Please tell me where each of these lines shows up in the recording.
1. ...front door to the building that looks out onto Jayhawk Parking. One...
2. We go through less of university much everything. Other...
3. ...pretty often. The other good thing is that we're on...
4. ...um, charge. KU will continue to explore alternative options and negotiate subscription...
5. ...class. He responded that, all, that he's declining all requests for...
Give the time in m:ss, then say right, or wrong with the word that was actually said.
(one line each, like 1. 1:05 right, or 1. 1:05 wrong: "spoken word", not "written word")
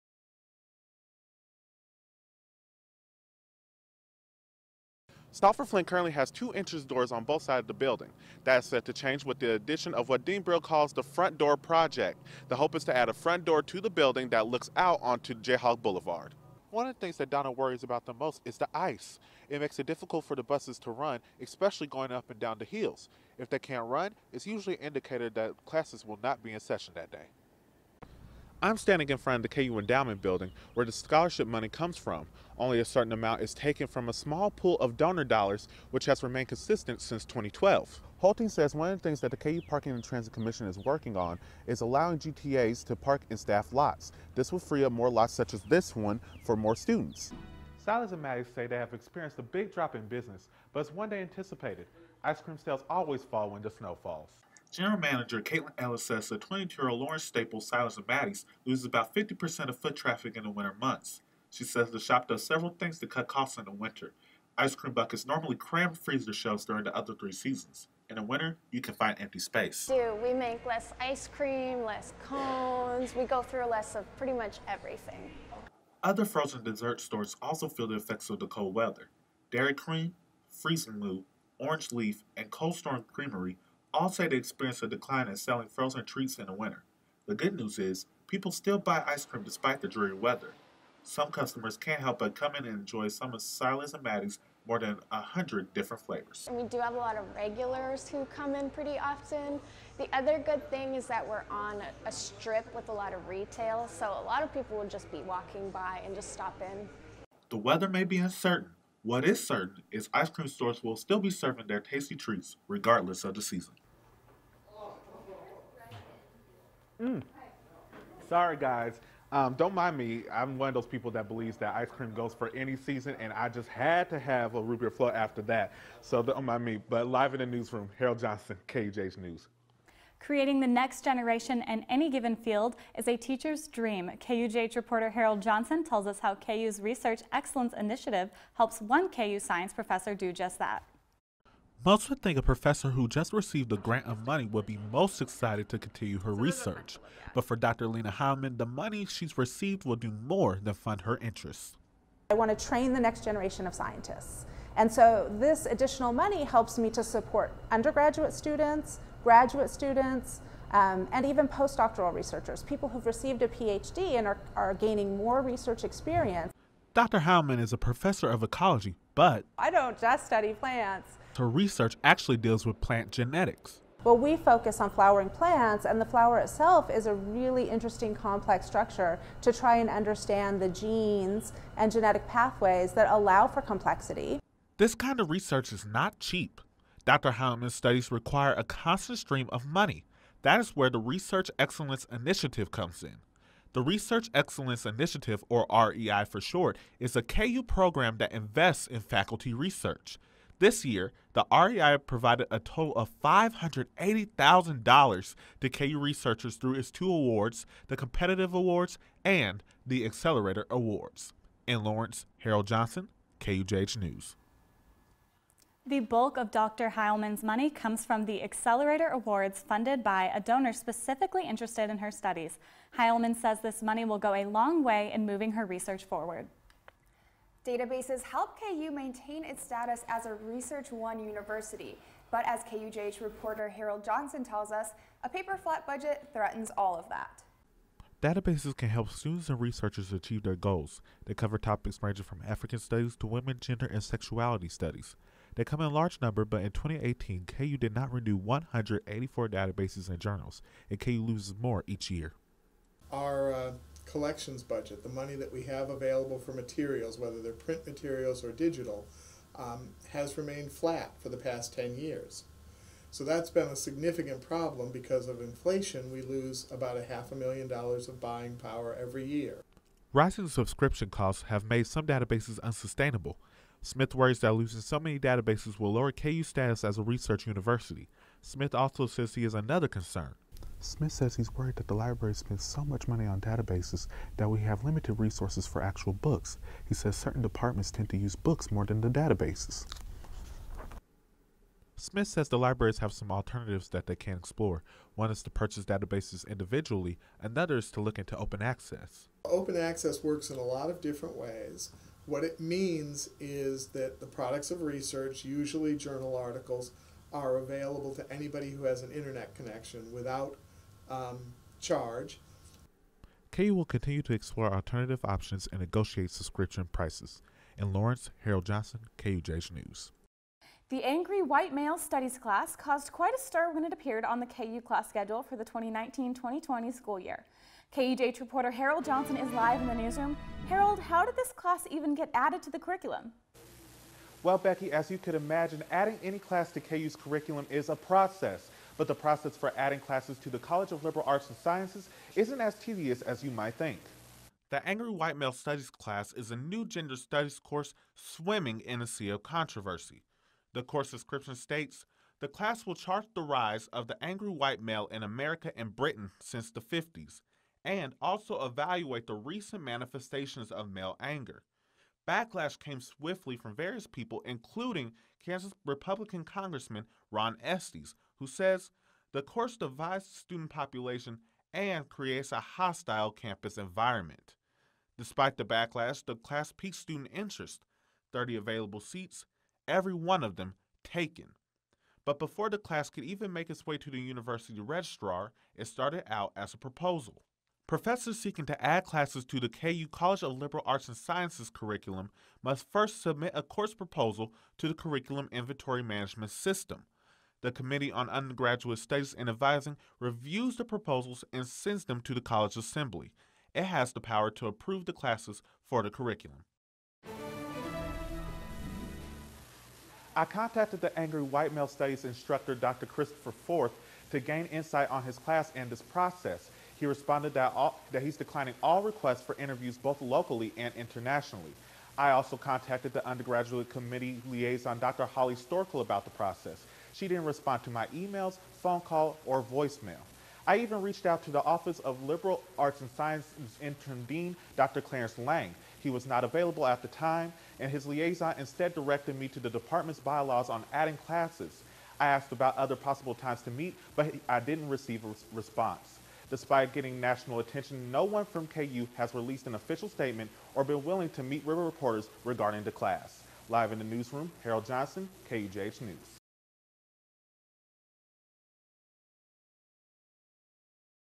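1. 0:13 wrong: "Boulevard", not "Parking"
2. 1:13 wrong: "pretty", not "university"
3. 1:38 right
4. 5:11 right
5. 6:56 wrong: "process", not "class".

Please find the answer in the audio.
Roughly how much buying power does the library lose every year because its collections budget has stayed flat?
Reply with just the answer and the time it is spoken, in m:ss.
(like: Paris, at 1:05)
half a million dollars, at 4:26.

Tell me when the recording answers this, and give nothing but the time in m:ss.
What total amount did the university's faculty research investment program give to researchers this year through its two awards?
3:23.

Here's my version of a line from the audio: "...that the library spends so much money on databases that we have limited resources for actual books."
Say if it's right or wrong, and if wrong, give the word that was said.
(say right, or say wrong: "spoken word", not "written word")
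right.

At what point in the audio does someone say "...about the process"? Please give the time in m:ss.
7:06.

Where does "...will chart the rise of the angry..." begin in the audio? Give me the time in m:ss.
5:52.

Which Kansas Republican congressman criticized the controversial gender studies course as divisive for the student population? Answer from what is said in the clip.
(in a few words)
Ron Estes.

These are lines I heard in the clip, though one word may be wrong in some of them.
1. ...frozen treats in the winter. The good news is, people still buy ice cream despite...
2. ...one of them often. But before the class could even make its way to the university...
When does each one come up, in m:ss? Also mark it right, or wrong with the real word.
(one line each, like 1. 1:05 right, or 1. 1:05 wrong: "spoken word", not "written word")
1. 1:25 right
2. 6:20 wrong: "taken", not "often".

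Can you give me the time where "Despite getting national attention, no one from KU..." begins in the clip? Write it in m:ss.
7:26.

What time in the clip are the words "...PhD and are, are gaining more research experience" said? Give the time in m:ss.
2:43.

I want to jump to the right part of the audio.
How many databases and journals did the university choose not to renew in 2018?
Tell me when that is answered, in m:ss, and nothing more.
4:08.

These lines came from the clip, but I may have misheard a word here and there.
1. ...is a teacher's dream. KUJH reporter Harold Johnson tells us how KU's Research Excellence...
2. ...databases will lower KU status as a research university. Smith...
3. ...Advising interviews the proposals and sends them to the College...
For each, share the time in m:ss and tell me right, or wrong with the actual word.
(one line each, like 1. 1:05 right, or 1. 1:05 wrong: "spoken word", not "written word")
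1. 2:12 right
2. 4:35 right
3. 6:39 wrong: "reviews", not "interviews".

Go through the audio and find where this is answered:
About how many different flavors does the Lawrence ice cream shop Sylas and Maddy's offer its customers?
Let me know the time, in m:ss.
1:34.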